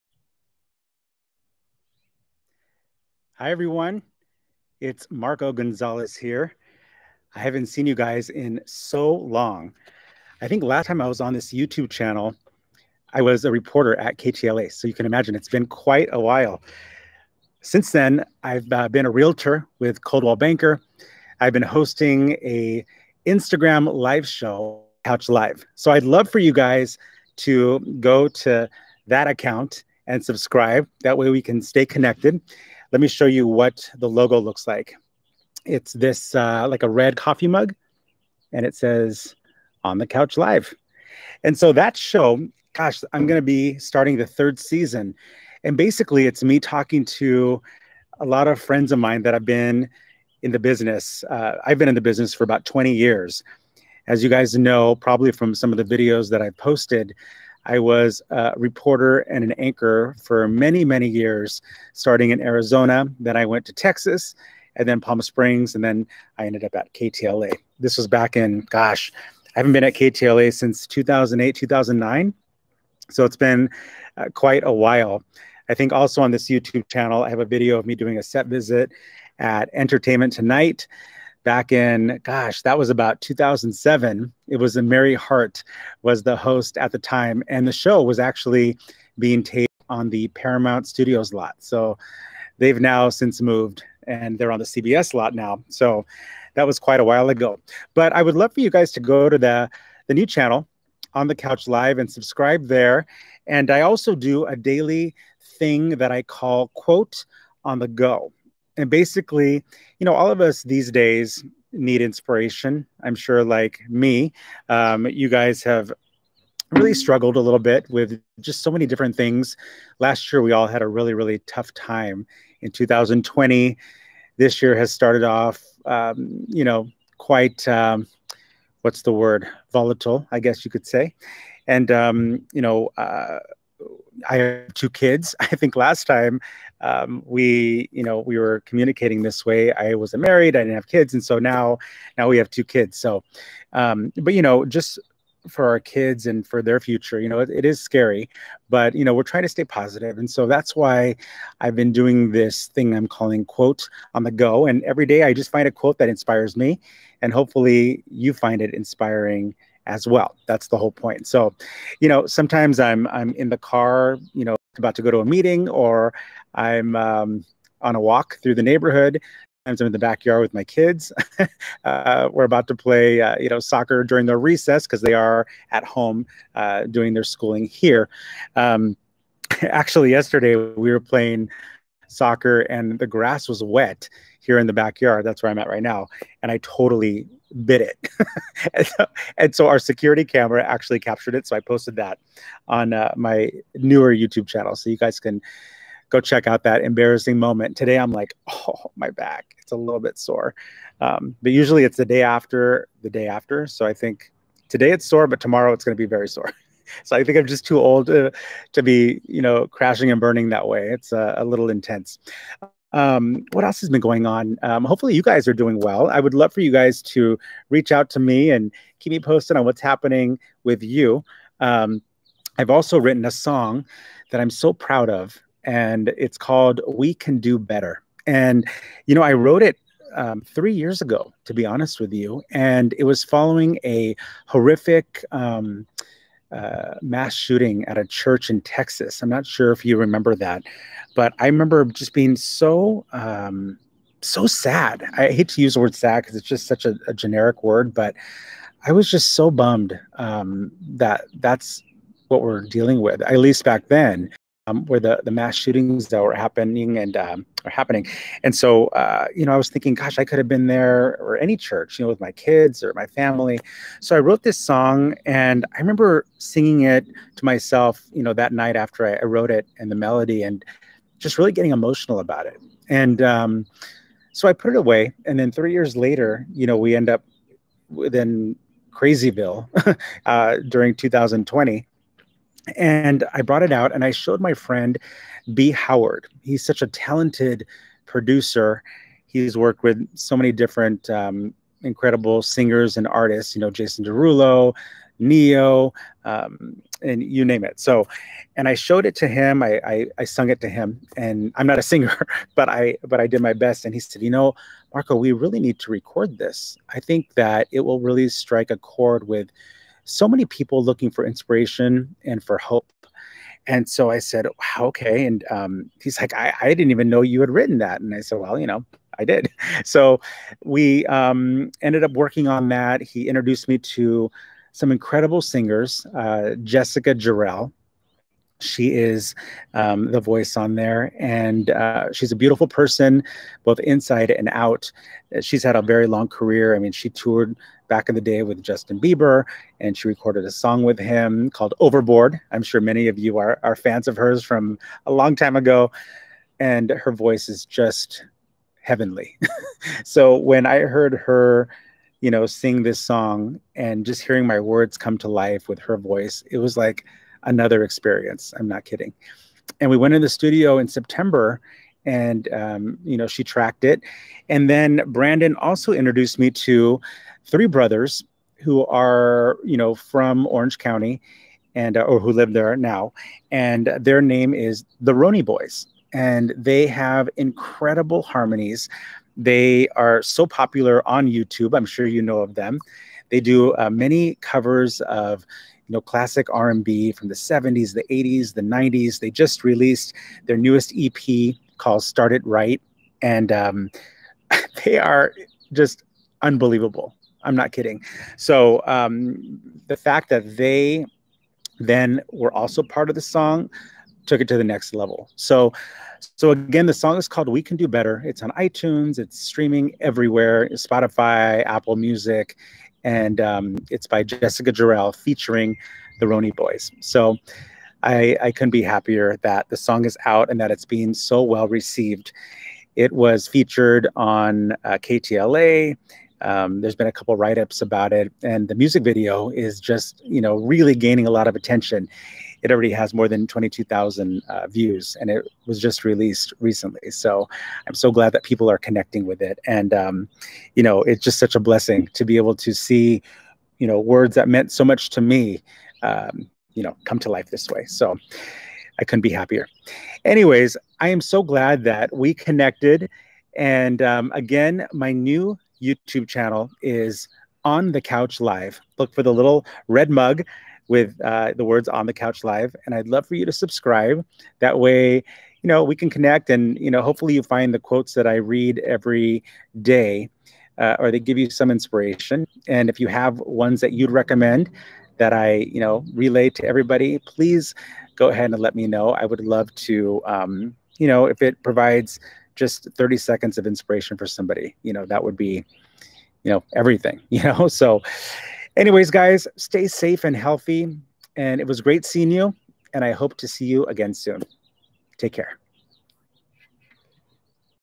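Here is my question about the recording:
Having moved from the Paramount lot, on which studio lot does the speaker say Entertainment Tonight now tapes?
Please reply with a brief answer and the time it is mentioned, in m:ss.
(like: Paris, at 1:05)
CBS lot, at 1:34.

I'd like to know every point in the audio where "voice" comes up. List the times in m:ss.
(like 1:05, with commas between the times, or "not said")
5:30, 5:47, 5:55.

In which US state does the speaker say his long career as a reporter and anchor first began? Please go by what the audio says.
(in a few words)
Arizona.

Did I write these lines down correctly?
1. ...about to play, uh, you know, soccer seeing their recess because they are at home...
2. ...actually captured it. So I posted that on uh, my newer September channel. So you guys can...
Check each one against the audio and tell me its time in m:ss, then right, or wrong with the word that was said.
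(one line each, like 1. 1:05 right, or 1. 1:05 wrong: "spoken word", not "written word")
1. 2:52 wrong: "during", not "seeing"
2. 3:10 wrong: "YouTube", not "September".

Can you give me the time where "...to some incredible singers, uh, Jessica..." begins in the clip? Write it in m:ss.
5:23.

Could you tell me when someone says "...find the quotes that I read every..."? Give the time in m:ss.
7:47.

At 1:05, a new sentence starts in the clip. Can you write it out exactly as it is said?
And then I ended up at KTLA.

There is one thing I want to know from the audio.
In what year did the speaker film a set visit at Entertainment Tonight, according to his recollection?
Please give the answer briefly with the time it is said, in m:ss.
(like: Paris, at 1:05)
2007, at 1:23.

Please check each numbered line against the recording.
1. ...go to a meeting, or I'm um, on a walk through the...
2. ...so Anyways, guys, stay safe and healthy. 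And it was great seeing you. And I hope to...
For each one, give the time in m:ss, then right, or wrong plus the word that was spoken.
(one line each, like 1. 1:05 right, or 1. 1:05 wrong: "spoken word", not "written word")
1. 2:45 right
2. 8:07 right.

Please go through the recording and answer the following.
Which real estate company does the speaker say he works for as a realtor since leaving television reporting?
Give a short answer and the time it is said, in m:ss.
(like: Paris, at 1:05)
Coldwell Banker, at 0:20.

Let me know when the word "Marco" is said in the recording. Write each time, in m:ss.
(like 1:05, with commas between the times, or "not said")
0:05, 5:04.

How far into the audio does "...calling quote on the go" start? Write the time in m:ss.
2:33.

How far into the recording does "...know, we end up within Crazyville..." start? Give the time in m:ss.
4:36.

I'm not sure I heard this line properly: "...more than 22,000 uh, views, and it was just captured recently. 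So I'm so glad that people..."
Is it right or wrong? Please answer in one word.
wrong.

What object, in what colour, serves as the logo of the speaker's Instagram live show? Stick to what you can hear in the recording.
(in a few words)
Red coffee mug.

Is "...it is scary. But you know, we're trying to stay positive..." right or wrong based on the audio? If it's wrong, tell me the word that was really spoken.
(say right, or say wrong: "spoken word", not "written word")
right.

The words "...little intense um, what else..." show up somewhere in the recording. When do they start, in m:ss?
3:31.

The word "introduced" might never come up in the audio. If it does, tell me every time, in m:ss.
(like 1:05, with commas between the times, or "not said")
5:23, 6:05.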